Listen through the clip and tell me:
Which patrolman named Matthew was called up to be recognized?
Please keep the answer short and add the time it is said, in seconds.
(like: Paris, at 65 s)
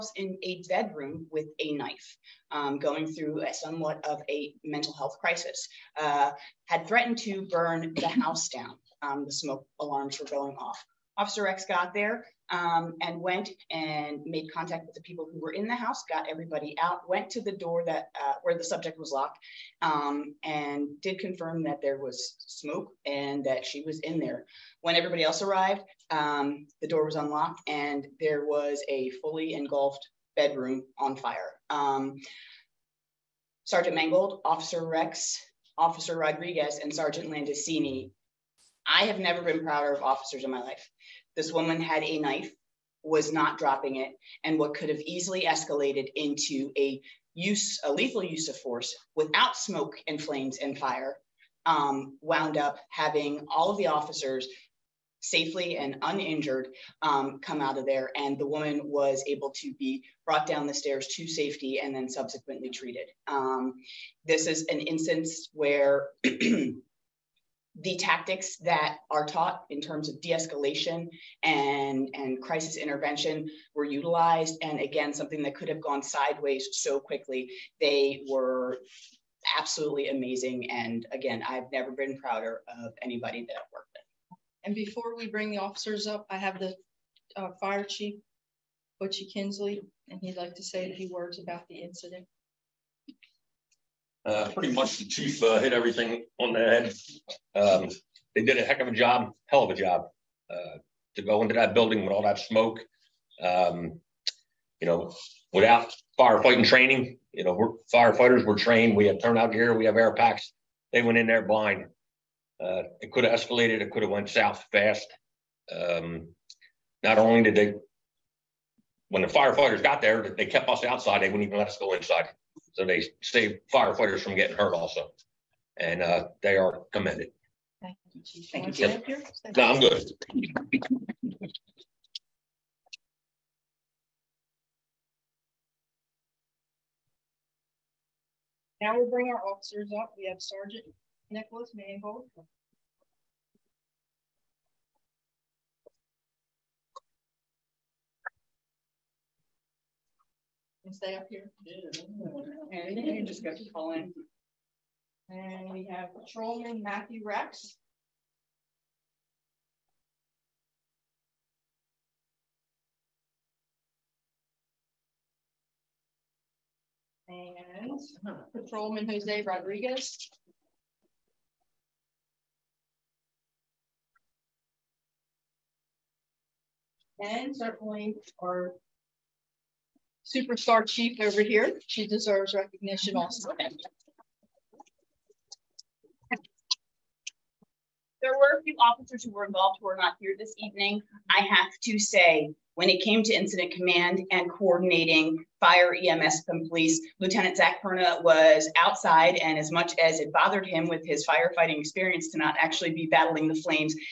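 Matthew Rex, at 156 s.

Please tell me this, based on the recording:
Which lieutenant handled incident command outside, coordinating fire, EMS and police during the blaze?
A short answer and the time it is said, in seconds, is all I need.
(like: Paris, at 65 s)
Zach Perna, at 197 s.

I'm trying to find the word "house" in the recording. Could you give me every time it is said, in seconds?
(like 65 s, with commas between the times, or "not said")
8 s, 15 s.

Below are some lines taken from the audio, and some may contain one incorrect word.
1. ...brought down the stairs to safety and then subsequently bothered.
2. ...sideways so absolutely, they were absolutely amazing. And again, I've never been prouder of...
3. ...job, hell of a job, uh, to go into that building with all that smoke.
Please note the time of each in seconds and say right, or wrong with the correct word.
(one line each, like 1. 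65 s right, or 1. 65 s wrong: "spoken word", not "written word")
1. 60 s wrong: "treated", not "bothered"
2. 76 s wrong: "quickly", not "absolutely"
3. 98 s right.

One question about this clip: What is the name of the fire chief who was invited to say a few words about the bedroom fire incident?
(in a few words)
Butchie Kinsley.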